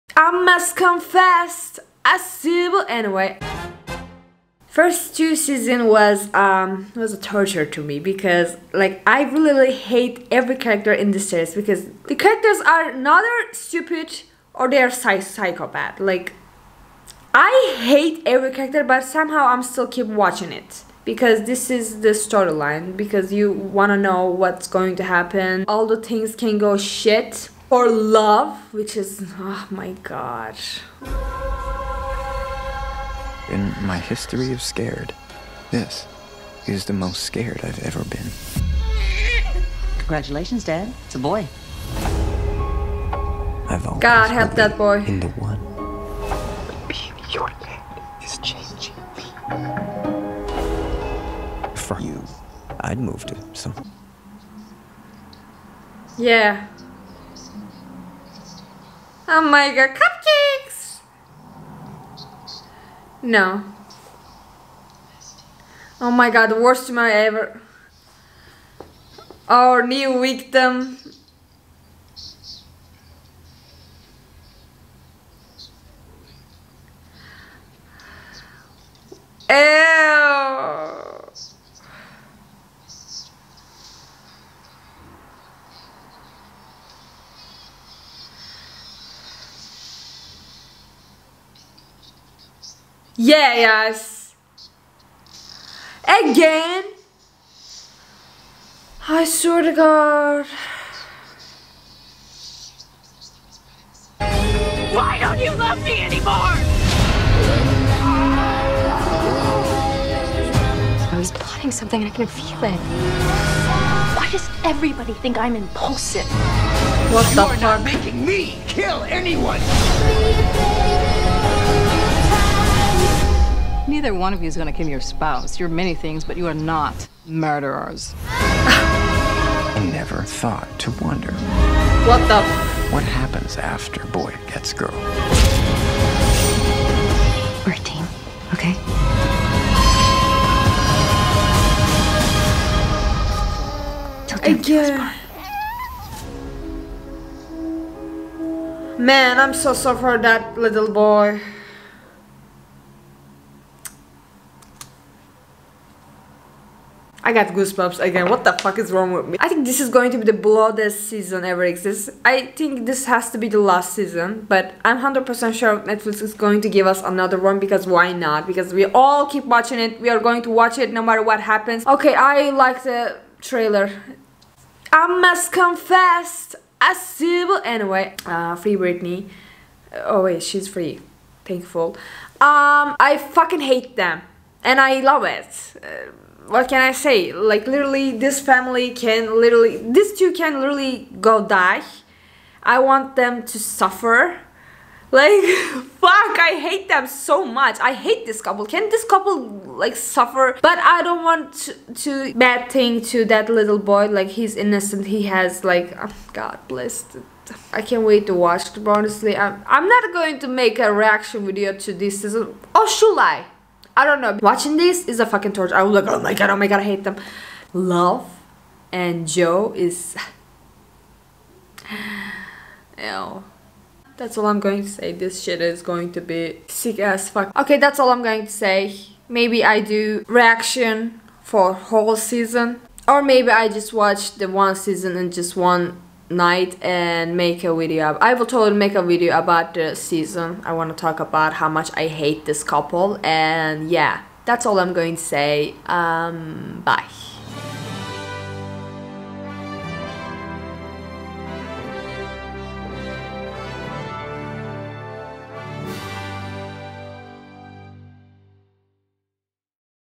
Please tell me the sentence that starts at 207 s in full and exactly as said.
I can't wait to watch it.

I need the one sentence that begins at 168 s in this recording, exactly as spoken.
Because we all keep watching it.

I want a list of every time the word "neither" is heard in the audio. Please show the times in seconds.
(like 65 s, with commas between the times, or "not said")
12 s, 124 s.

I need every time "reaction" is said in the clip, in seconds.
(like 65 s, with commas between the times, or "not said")
210 s, 230 s.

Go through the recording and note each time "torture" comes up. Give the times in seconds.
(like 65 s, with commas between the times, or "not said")
7 s, 215 s.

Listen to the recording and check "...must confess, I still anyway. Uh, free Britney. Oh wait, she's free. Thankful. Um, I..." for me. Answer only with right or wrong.
right.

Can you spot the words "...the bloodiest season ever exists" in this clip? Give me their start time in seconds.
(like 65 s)
160 s.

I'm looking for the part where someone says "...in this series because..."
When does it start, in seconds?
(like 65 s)
10 s.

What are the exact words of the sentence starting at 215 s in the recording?
I was like, oh my god, oh my god, I hate them.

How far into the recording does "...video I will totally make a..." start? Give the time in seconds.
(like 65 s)
237 s.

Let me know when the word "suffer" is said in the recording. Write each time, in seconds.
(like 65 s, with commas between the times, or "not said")
193 s, 199 s.